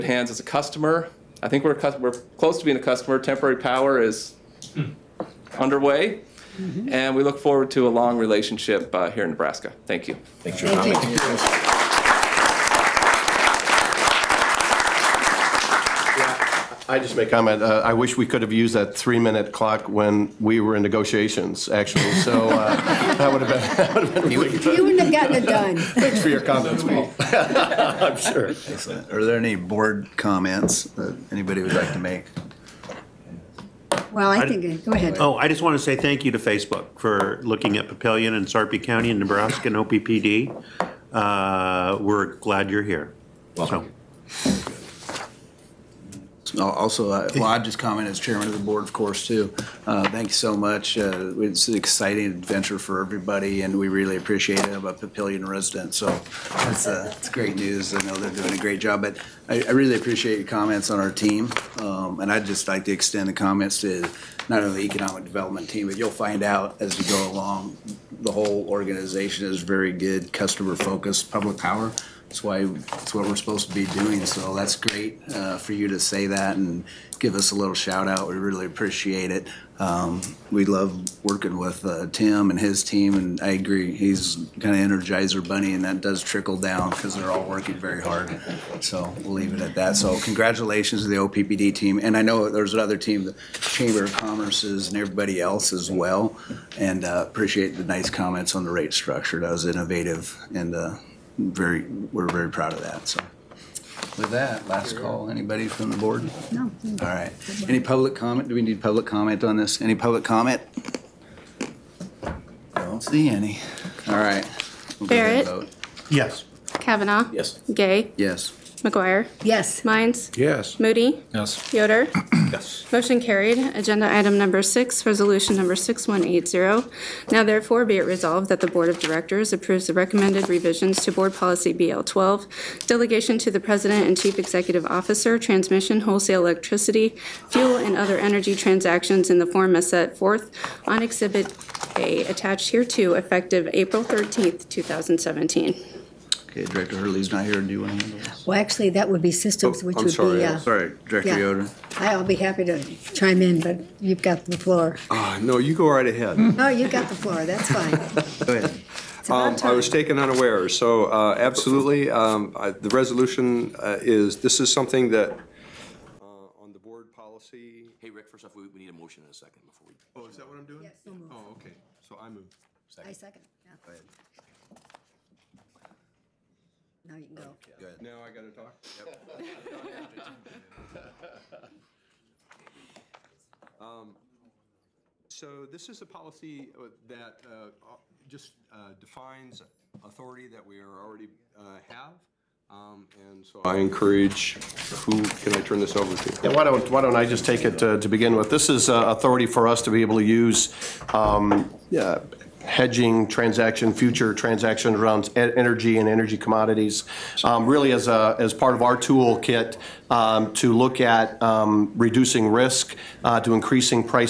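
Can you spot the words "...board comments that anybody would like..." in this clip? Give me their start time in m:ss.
0:29.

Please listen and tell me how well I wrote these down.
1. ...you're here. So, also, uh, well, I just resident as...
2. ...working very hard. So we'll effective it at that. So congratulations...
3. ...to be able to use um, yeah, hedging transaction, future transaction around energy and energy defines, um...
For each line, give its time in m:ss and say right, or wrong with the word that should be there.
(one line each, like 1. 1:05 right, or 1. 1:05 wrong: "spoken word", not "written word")
1. 0:42 wrong: "comment", not "resident"
2. 1:27 wrong: "leave", not "effective"
3. 3:19 wrong: "commodities", not "defines".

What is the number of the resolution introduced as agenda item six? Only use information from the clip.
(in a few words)
6180.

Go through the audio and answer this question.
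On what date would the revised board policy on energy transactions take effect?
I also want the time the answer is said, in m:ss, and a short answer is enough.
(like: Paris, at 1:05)
April 13th, 2017, at 2:23.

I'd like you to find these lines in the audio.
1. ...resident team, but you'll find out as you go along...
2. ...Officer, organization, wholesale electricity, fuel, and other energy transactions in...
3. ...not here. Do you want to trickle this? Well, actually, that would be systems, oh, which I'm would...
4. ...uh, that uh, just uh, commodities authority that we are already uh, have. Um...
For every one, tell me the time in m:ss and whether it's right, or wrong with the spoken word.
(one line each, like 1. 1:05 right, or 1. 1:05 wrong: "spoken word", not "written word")
1. 1:05 wrong: "development", not "resident"
2. 2:14 wrong: "transmission", not "organization"
3. 2:27 wrong: "handle", not "trickle"
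4. 3:06 wrong: "defines", not "commodities".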